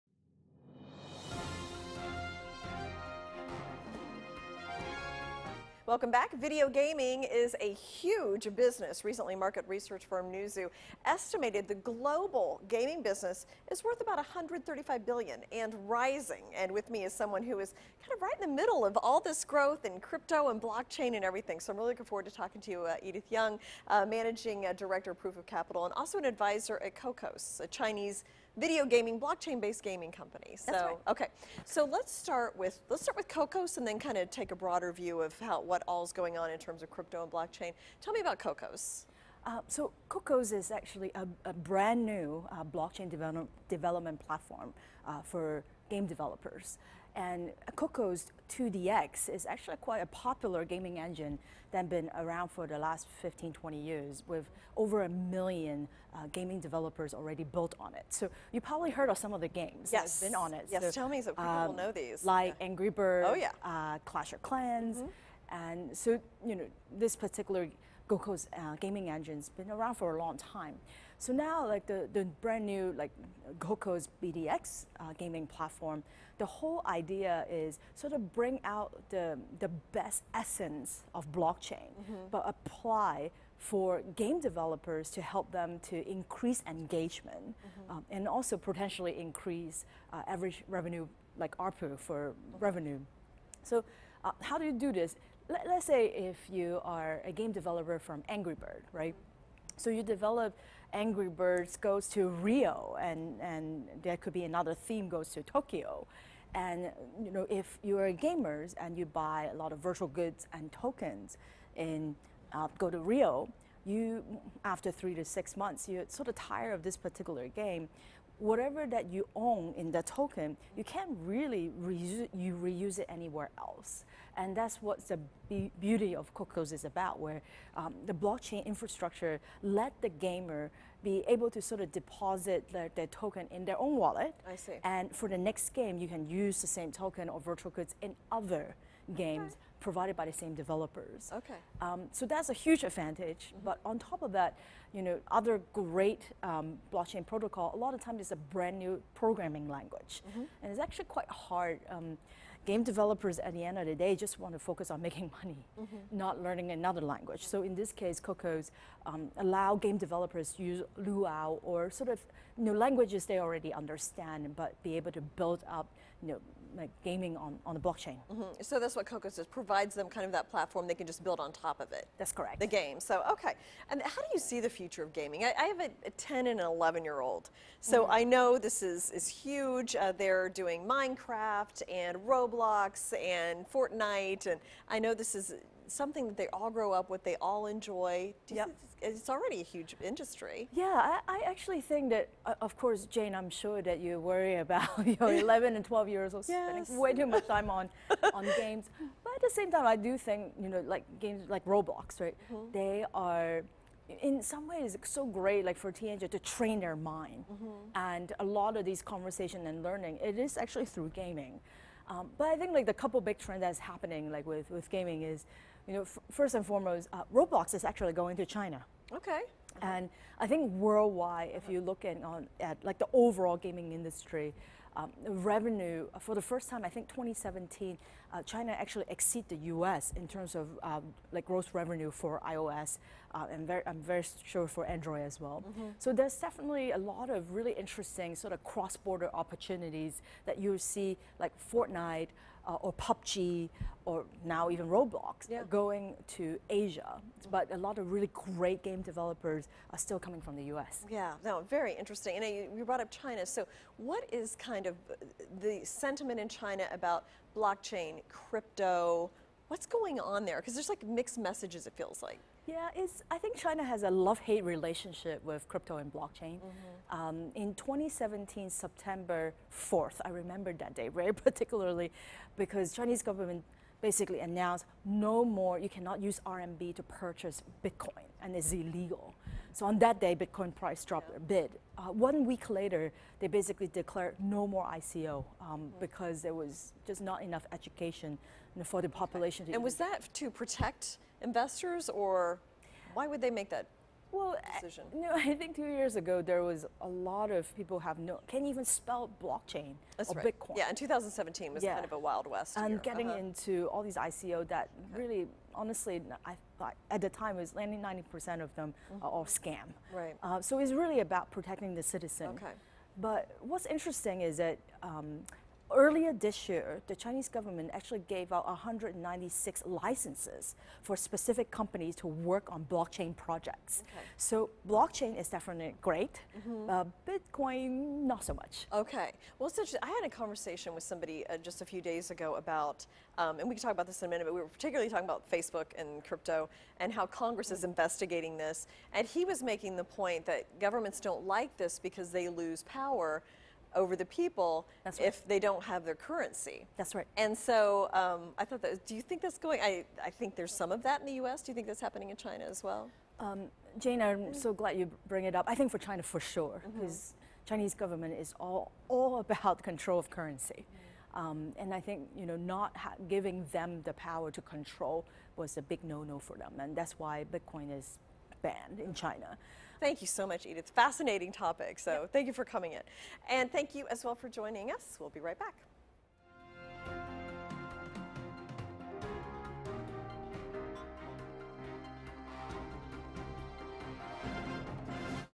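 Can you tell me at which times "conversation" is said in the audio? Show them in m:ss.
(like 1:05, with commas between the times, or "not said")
3:29, 5:30.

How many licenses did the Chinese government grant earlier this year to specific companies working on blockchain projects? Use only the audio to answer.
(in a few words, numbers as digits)
196.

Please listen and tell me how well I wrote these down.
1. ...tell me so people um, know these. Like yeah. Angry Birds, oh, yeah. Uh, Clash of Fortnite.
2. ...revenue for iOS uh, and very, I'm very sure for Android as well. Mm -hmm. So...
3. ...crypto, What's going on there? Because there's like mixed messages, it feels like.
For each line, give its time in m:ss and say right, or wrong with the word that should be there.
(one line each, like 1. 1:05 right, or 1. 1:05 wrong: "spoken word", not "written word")
1. 1:00 wrong: "Clans", not "Fortnite"
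2. 3:51 right
3. 4:18 right.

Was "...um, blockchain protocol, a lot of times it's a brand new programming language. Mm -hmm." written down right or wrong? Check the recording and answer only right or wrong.
right.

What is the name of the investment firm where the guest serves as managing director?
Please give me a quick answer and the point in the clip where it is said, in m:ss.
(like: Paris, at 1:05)
Proof of Capital, at 0:25.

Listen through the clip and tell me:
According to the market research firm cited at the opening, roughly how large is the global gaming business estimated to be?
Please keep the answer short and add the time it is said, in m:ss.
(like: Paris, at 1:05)
135 billion, at 0:14.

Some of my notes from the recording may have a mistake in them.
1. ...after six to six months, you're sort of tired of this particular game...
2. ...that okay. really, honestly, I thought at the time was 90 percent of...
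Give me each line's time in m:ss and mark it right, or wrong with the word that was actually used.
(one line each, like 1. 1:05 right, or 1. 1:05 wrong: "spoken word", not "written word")
1. 1:54 wrong: "three", not "six"
2. 5:04 right.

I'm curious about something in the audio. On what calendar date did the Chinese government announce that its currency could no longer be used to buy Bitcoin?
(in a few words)
September 4th.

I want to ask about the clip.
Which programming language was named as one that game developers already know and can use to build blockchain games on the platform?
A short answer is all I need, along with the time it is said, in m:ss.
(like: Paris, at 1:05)
Lua, at 2:40.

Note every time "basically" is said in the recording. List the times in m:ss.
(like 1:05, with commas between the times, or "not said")
4:34, 4:43.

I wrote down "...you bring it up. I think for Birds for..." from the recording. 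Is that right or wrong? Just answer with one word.
wrong.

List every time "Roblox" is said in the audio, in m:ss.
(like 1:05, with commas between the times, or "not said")
3:02, 3:21, 3:37, 4:04.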